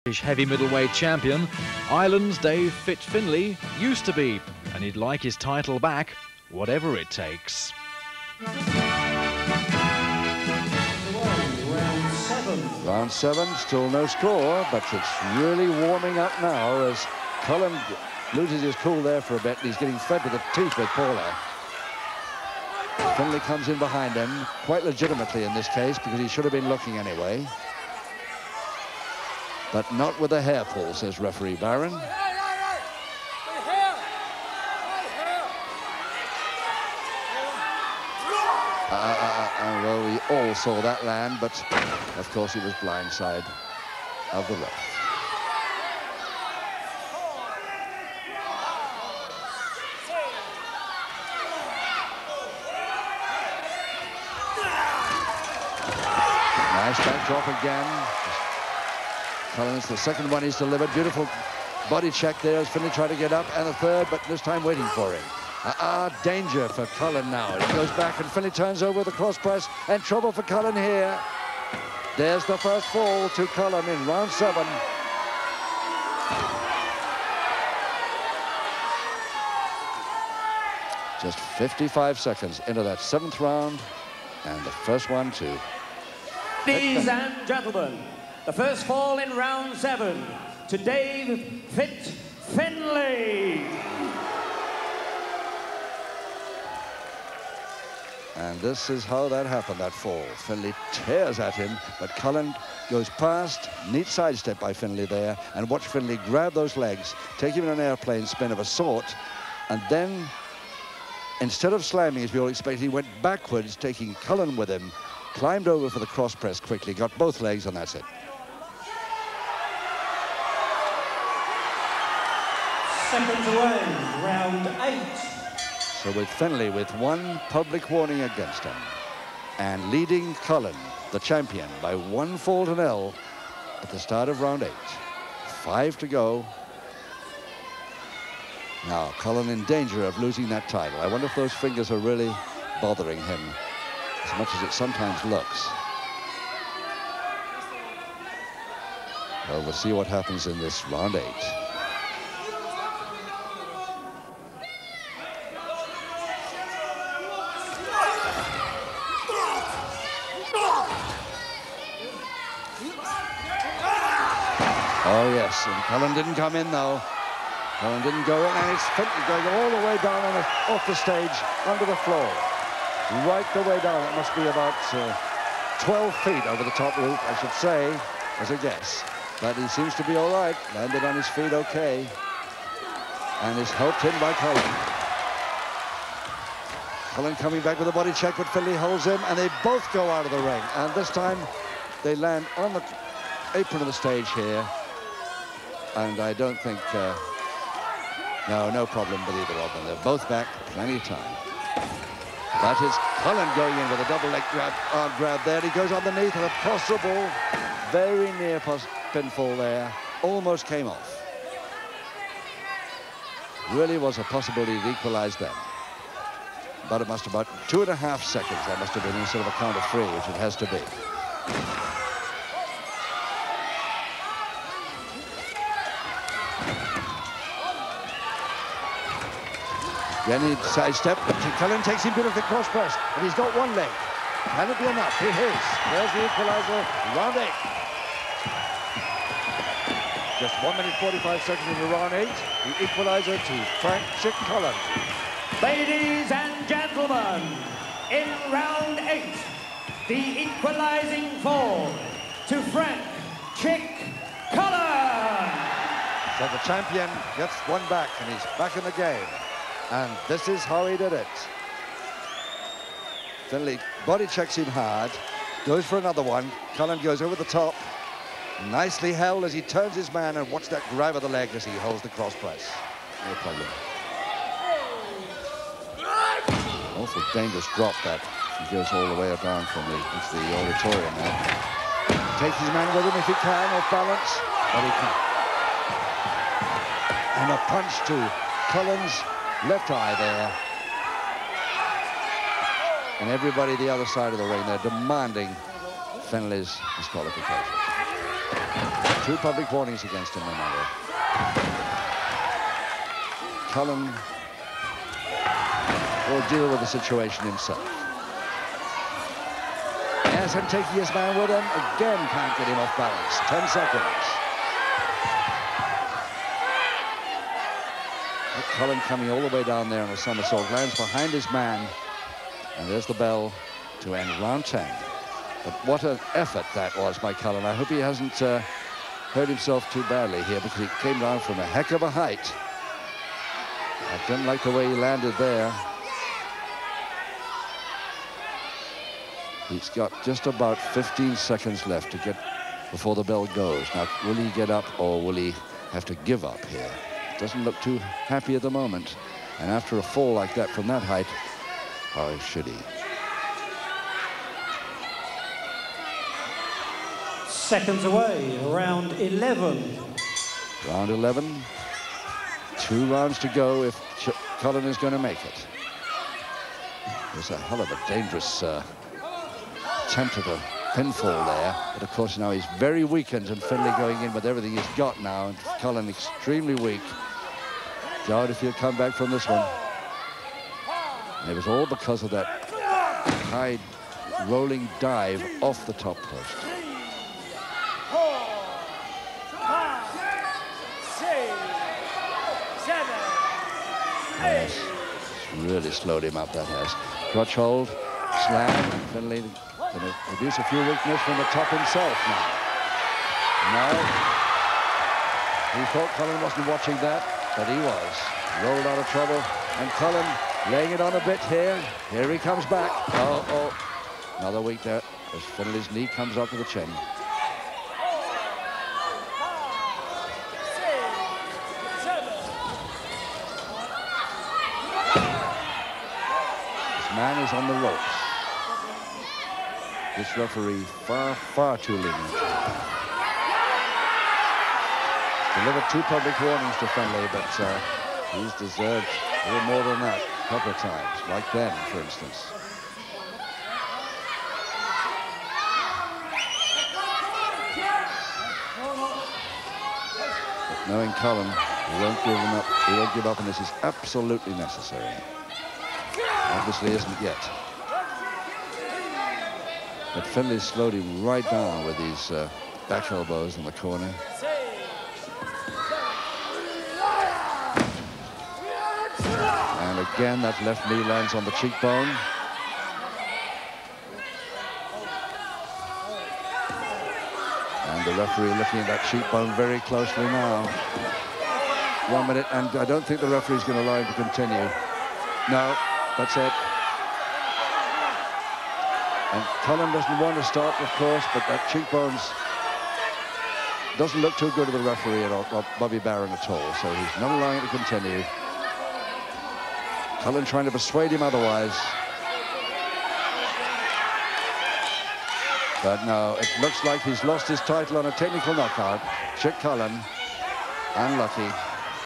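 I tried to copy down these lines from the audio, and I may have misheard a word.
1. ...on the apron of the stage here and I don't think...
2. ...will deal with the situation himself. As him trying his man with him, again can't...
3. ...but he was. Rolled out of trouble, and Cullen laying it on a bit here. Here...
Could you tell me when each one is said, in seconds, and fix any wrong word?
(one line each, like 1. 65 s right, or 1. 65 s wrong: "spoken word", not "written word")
1. 192 s right
2. 306 s wrong: "taking", not "trying"
3. 407 s right.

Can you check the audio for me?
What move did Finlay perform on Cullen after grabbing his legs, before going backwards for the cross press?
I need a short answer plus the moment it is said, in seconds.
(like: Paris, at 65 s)
airplane spin, at 107 s.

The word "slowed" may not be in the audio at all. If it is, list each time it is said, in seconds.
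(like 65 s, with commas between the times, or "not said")
395 s, 460 s.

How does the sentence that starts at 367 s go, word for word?
There's a hell of a dangerous uh, attempt at a pinfall there.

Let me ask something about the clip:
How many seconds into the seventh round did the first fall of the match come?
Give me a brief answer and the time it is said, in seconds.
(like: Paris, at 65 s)
55, at 81 s.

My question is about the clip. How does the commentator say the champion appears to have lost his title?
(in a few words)
technical knockout.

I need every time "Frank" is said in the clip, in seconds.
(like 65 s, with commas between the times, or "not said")
243 s, 252 s.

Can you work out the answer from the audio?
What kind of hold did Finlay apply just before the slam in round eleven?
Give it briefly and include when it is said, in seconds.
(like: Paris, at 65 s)
Crutch hold, at 397 s.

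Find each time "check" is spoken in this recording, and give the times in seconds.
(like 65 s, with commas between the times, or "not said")
62 s, 188 s, 264 s.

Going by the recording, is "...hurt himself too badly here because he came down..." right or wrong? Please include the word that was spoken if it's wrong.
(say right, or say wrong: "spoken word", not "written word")
right.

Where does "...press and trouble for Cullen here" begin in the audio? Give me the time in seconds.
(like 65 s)
69 s.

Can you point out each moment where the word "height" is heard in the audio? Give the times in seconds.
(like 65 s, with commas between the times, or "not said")
332 s, 351 s.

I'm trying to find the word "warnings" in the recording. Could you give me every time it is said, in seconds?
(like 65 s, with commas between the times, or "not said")
127 s, 299 s, 436 s.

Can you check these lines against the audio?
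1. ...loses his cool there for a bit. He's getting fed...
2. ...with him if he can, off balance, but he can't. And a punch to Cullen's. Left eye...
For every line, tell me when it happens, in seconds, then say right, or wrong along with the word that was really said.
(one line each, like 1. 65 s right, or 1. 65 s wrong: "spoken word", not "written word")
1. 18 s right
2. 282 s right.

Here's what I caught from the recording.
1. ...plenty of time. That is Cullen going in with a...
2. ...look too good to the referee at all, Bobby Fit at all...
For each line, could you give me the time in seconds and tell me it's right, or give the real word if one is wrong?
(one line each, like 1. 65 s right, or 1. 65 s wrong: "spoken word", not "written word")
1. 200 s right
2. 494 s wrong: "Barron", not "Fit".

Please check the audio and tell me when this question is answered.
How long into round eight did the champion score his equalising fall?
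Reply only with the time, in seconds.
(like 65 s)
240 s.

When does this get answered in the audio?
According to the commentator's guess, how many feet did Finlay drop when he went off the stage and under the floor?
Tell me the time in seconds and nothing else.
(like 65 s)
175 s.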